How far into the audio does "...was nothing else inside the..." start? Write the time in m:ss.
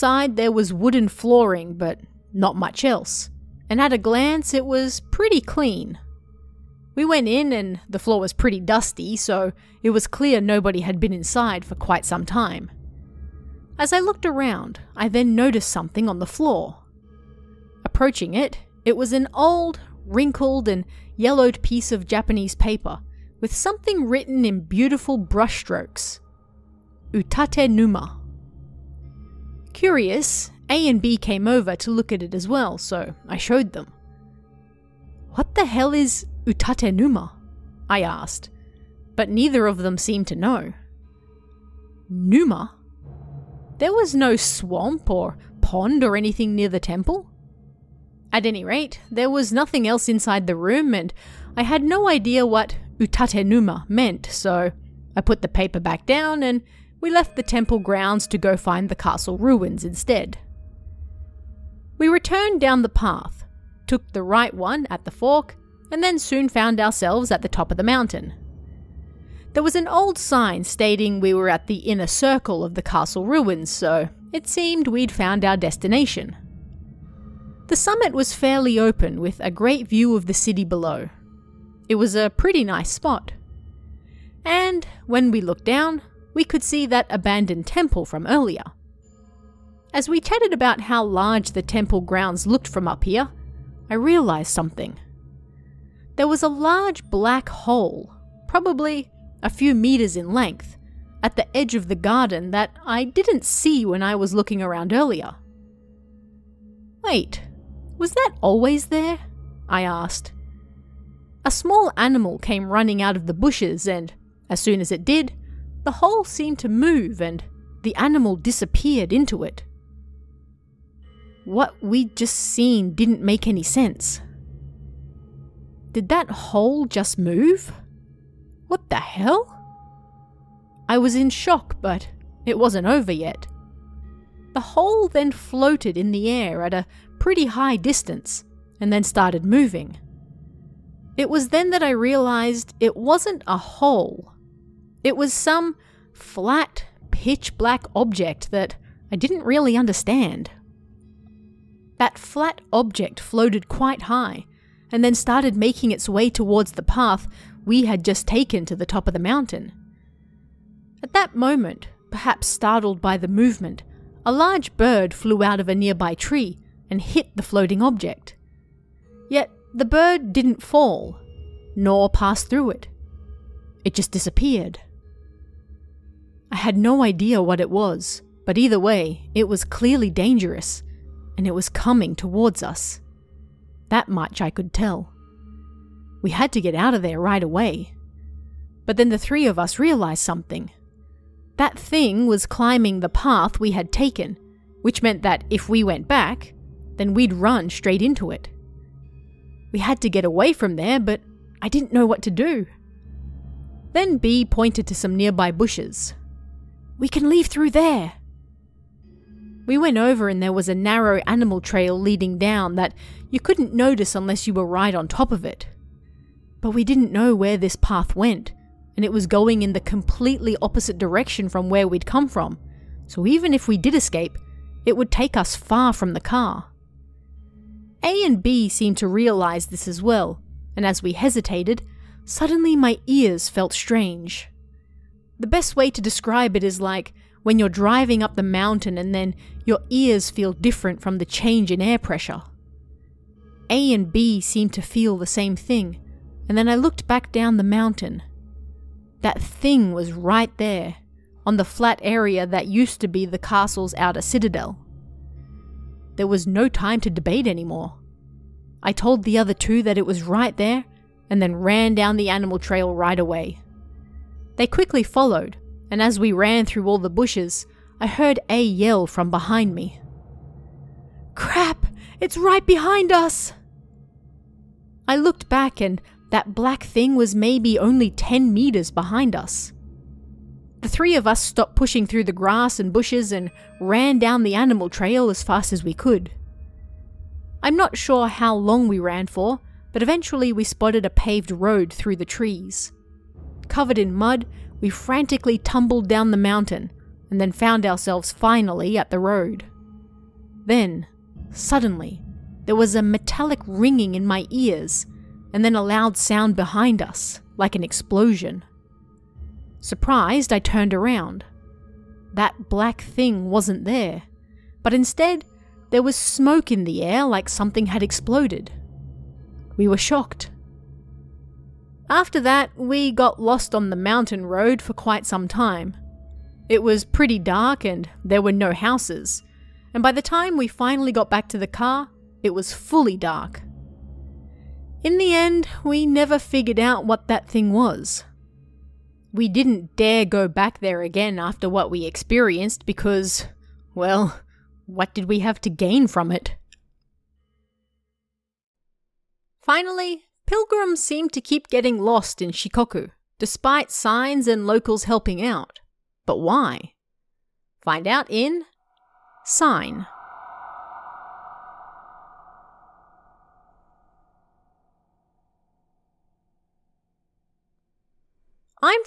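0:49.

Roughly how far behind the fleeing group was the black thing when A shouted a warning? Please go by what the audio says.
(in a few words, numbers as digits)
10 meters.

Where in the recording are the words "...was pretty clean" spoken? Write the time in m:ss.
0:04.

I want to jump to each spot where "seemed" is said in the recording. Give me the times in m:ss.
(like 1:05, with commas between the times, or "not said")
0:39, 1:14, 1:56, 3:48, 4:04, 5:51.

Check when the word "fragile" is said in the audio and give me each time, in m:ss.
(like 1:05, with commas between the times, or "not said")
not said.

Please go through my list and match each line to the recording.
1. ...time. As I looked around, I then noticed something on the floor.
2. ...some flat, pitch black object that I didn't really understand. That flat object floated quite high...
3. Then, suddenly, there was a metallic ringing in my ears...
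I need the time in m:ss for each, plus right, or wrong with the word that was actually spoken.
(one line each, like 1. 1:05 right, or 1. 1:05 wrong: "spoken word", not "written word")
1. 0:12 right
2. 2:25 right
3. 5:00 right.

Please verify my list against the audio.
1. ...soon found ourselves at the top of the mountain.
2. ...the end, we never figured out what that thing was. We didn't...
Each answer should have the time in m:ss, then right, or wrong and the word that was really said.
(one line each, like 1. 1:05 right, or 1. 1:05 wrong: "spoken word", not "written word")
1. 1:06 right
2. 5:35 right.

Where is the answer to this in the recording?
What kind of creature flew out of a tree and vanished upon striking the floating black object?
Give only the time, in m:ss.
2:44.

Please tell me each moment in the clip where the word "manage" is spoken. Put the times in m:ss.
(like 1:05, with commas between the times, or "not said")
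not said.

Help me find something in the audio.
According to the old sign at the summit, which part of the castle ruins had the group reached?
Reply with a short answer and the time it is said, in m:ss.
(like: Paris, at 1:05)
inner circle, at 1:11.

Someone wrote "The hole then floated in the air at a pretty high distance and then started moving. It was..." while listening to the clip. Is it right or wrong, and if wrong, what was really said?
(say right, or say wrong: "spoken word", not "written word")
right.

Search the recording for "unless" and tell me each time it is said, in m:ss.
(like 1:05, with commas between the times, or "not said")
3:34.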